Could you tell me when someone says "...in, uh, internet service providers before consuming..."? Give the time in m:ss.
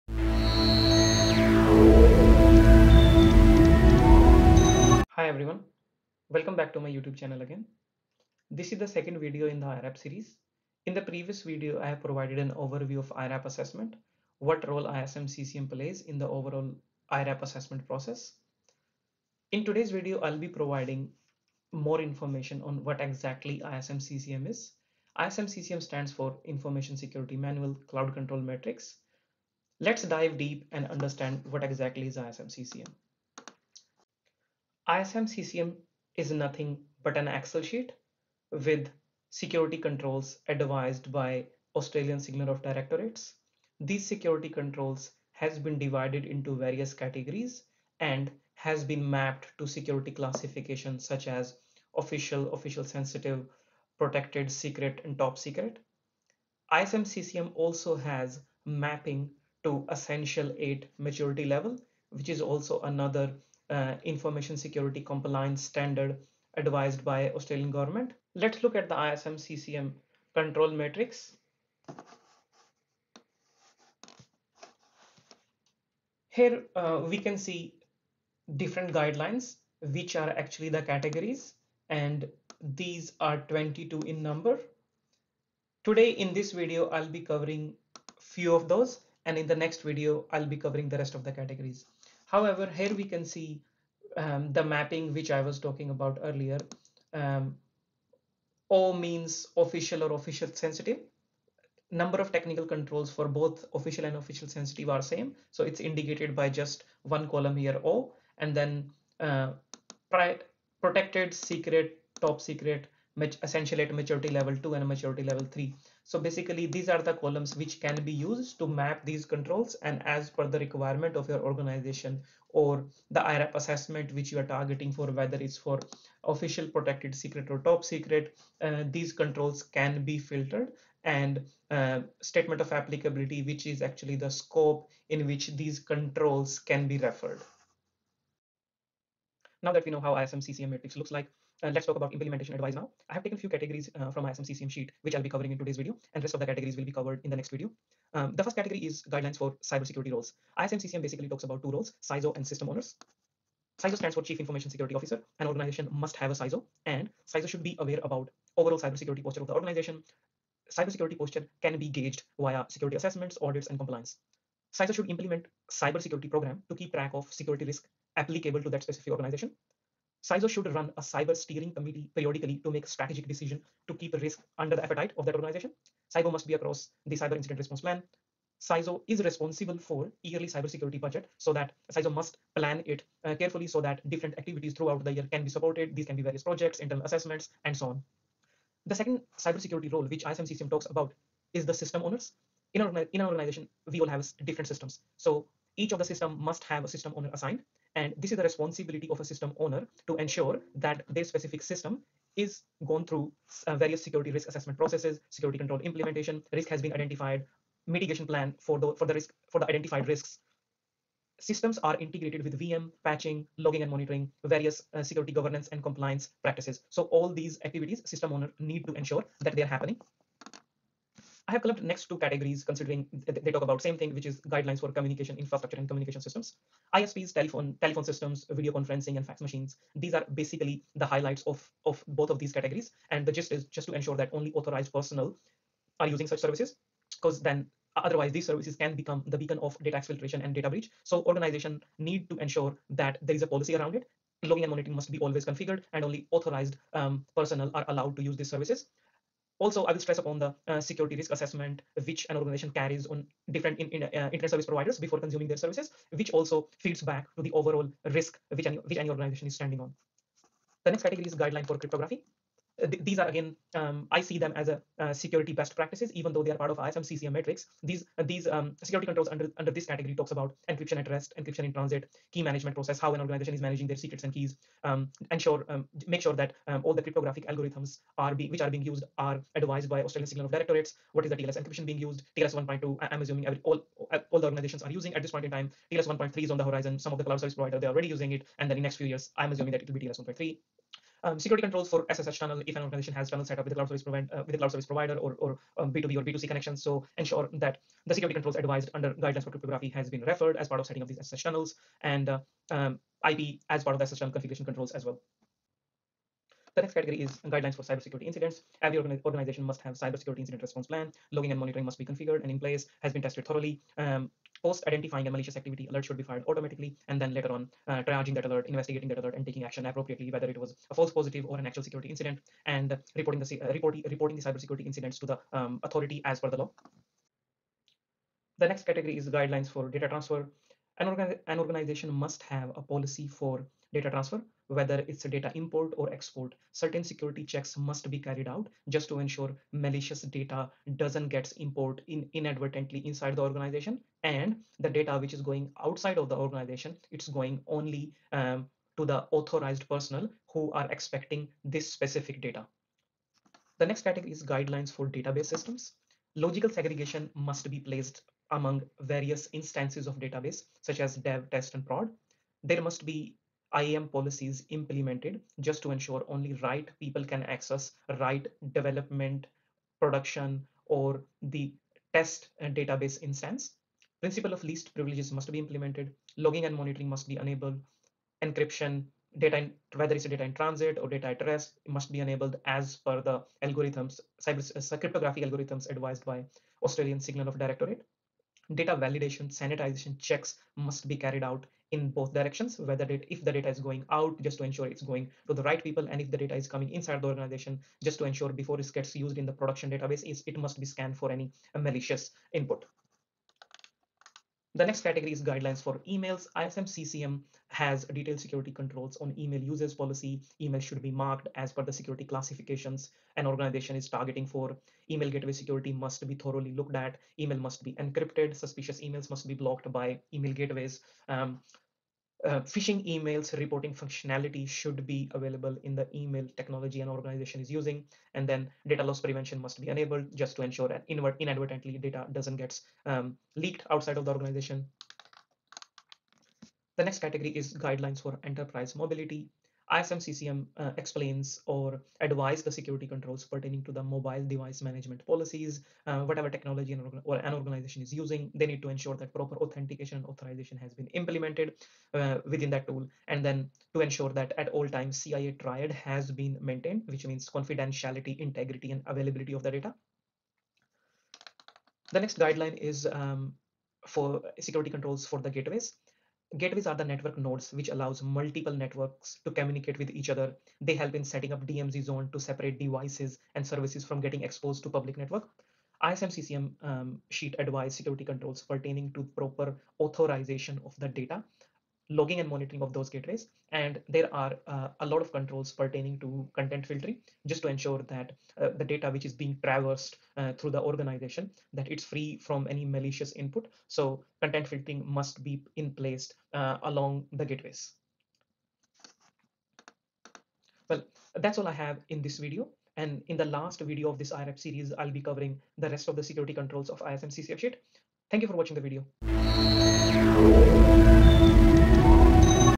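4:13.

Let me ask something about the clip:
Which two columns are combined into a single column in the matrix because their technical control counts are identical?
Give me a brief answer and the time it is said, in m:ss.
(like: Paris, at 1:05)
official and official sensitive, at 1:43.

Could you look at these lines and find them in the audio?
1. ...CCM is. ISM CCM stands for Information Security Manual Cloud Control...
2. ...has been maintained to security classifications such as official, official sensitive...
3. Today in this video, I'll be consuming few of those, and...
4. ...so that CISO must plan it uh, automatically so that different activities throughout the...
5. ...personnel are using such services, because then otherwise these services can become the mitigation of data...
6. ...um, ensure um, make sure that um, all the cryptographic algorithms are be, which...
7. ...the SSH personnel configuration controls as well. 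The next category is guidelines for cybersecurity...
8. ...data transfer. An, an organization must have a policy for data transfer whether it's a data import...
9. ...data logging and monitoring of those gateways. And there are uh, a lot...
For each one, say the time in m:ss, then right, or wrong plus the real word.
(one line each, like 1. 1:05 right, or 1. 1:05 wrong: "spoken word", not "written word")
1. 0:23 right
2. 0:48 wrong: "mapped", not "maintained"
3. 1:25 wrong: "covering", not "consuming"
4. 3:01 wrong: "carefully", not "automatically"
5. 3:54 wrong: "beacon", not "mitigation"
6. 4:34 right
7. 5:03 wrong: "tunnel", not "personnel"
8. 5:29 right
9. 8:01 right.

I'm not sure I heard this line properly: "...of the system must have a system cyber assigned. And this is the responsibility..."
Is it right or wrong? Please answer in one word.
wrong.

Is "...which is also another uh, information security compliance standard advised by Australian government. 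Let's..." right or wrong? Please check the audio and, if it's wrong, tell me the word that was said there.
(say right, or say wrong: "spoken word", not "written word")
right.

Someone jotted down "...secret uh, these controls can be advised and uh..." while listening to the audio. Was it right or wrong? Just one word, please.
wrong.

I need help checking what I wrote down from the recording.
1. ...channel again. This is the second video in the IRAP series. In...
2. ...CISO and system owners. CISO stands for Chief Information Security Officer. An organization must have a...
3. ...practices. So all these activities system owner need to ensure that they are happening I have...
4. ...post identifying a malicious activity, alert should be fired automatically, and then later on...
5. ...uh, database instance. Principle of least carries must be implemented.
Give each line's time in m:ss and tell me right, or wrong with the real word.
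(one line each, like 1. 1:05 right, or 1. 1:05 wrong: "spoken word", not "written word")
1. 0:07 right
2. 2:32 right
3. 3:36 right
4. 5:14 right
5. 6:12 wrong: "privileges", not "carries".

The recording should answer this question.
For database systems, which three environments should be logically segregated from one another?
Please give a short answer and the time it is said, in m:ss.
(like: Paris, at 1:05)
dev, test, and prod, at 6:01.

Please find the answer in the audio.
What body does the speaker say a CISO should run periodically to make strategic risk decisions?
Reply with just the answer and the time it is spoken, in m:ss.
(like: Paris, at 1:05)
cyber steering committee, at 2:51.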